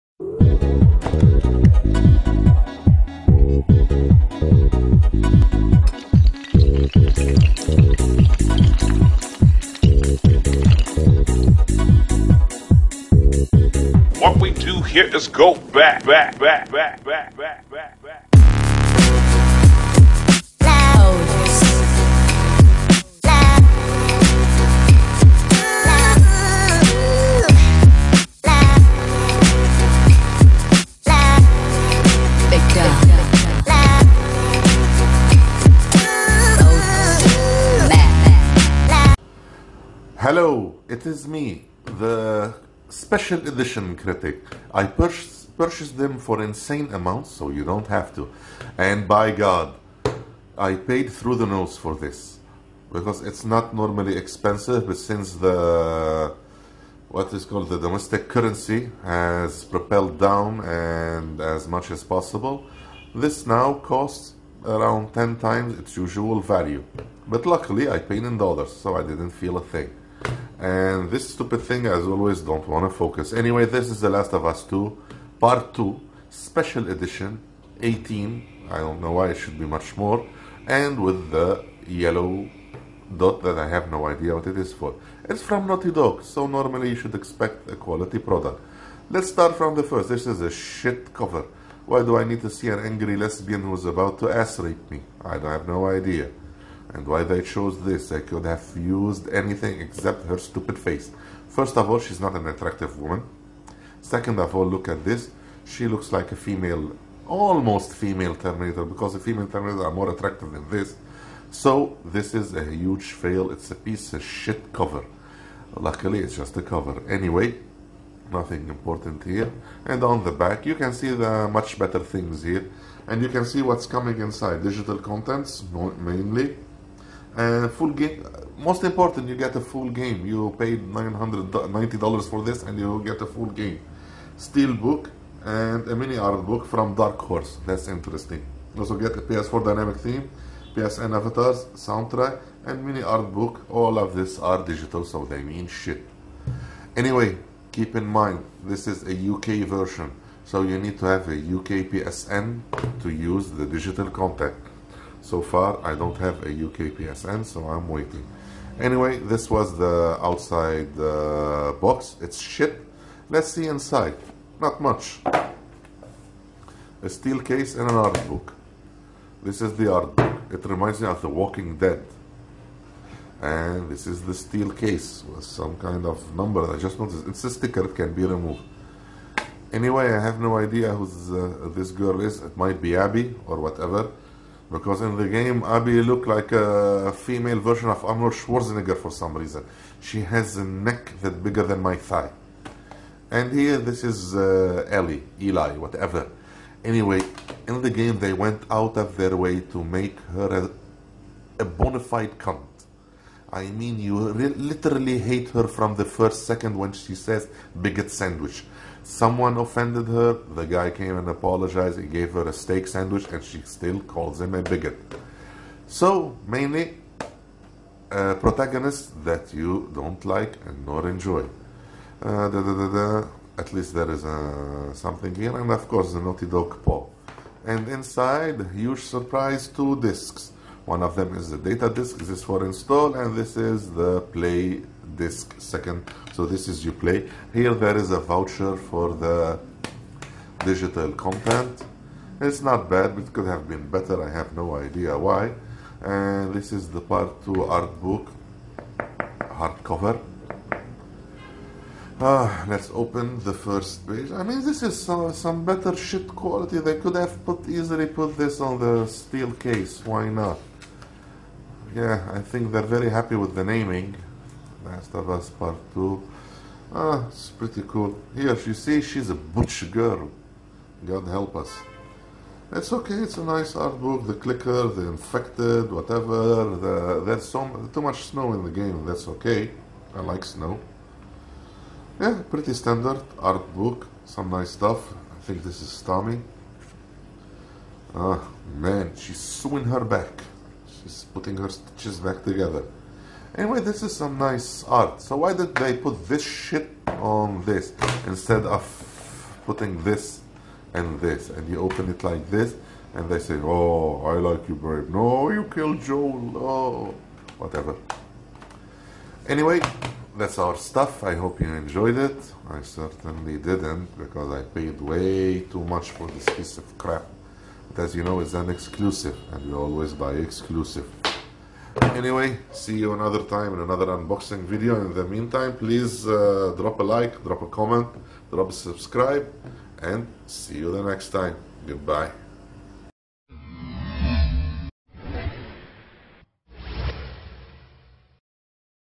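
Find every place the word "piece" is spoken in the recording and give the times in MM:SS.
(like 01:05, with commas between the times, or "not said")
01:53, 05:16.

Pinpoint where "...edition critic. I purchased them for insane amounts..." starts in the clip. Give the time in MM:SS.
00:43.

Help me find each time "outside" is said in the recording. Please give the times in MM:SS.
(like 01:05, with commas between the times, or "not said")
02:40.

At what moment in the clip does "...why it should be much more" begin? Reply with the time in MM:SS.
01:19.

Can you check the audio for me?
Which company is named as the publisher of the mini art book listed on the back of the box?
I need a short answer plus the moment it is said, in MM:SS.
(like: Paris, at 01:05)
Dark Horse, at 02:16.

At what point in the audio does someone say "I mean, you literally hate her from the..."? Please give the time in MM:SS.
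03:23.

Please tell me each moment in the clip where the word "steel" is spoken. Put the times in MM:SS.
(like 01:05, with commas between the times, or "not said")
02:14, 02:47, 02:54, 04:19.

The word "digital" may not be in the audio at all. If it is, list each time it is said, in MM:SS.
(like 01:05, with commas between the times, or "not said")
02:04, 02:24, 02:33, 04:00.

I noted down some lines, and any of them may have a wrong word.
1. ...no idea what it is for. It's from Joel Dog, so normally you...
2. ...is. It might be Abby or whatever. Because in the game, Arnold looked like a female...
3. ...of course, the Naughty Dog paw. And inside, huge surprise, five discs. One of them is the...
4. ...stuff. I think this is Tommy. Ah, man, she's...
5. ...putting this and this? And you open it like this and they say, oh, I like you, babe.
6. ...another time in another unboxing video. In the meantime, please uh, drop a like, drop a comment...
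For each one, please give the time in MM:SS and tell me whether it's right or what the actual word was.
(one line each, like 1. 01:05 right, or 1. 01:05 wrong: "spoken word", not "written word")
1. 01:23 wrong: "Naughty", not "Joel"
2. 03:02 wrong: "Abby", not "Arnold"
3. 03:45 wrong: "two", not "five"
4. 04:44 right
5. 04:59 right
6. 05:23 right.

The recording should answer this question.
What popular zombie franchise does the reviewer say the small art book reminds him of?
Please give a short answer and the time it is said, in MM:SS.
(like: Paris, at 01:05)
The Walking Dead, at 02:51.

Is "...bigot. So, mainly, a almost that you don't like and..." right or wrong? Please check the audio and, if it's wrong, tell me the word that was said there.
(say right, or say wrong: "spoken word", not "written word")
wrong: "protagonist", not "almost".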